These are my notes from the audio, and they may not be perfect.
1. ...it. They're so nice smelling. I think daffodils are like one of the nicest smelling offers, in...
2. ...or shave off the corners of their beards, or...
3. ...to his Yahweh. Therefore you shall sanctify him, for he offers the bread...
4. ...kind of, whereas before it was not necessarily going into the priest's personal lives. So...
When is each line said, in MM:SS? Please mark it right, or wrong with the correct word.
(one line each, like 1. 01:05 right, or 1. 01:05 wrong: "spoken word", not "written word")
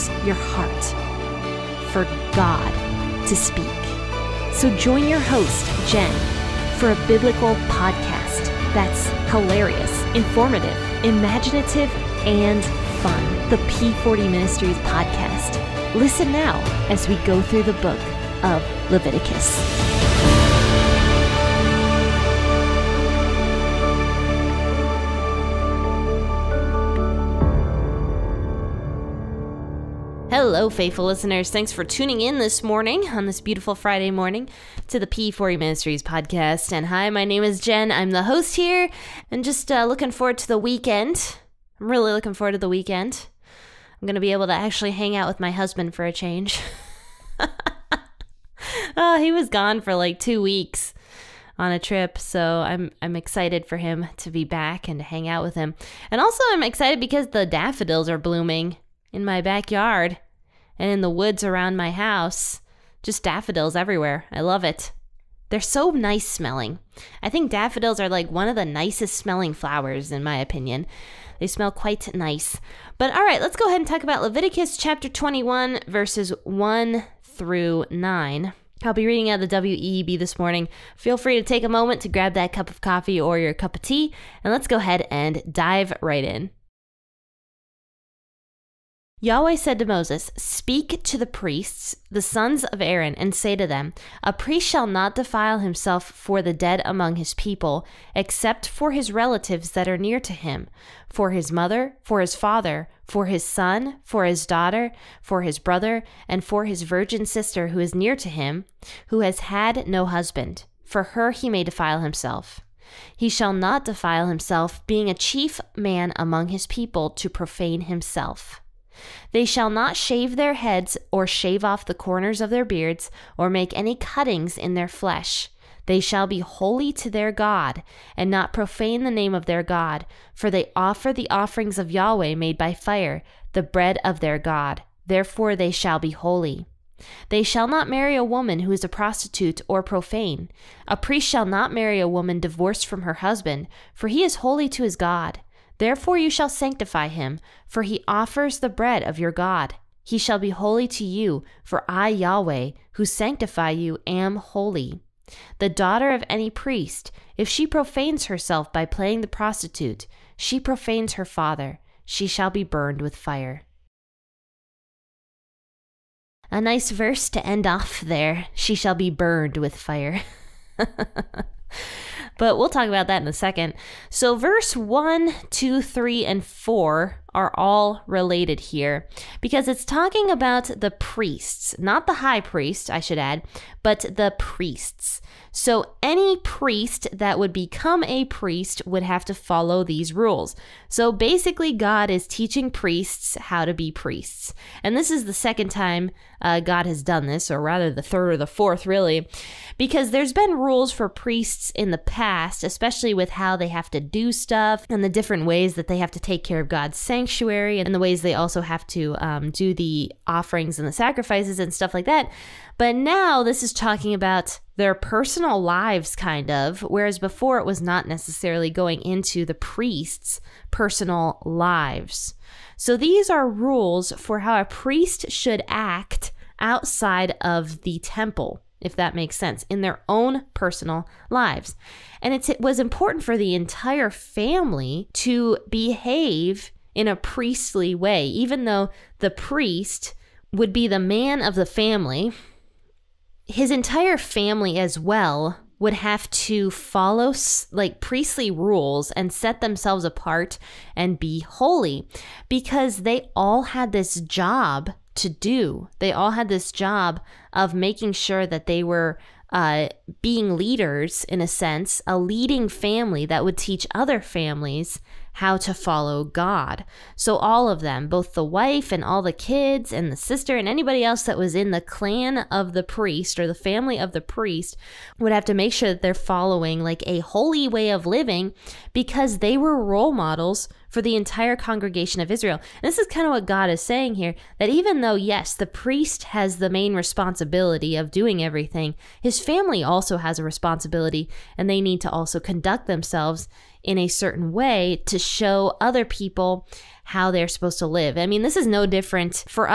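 1. 01:04 wrong: "flowers", not "offers"
2. 02:01 right
3. 02:24 wrong: "God", not "Yahweh"
4. 03:36 right.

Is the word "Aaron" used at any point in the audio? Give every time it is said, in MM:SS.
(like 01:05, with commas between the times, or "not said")
01:32.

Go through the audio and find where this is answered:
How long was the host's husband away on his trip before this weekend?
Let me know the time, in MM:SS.
00:50.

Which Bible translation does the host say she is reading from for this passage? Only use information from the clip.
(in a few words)
WEB.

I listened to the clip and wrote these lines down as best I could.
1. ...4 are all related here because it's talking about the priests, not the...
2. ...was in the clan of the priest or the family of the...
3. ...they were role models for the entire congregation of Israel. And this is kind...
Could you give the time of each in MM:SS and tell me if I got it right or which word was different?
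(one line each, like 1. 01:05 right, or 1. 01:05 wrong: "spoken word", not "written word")
1. 02:56 right
2. 04:31 right
3. 04:39 right.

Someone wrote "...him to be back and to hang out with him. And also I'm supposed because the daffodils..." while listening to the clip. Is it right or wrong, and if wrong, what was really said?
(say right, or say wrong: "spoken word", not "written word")
wrong: "excited", not "supposed".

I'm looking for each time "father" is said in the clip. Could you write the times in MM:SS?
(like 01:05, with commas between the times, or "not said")
01:42, 02:41.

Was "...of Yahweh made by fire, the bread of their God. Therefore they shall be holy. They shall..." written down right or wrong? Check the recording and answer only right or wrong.
right.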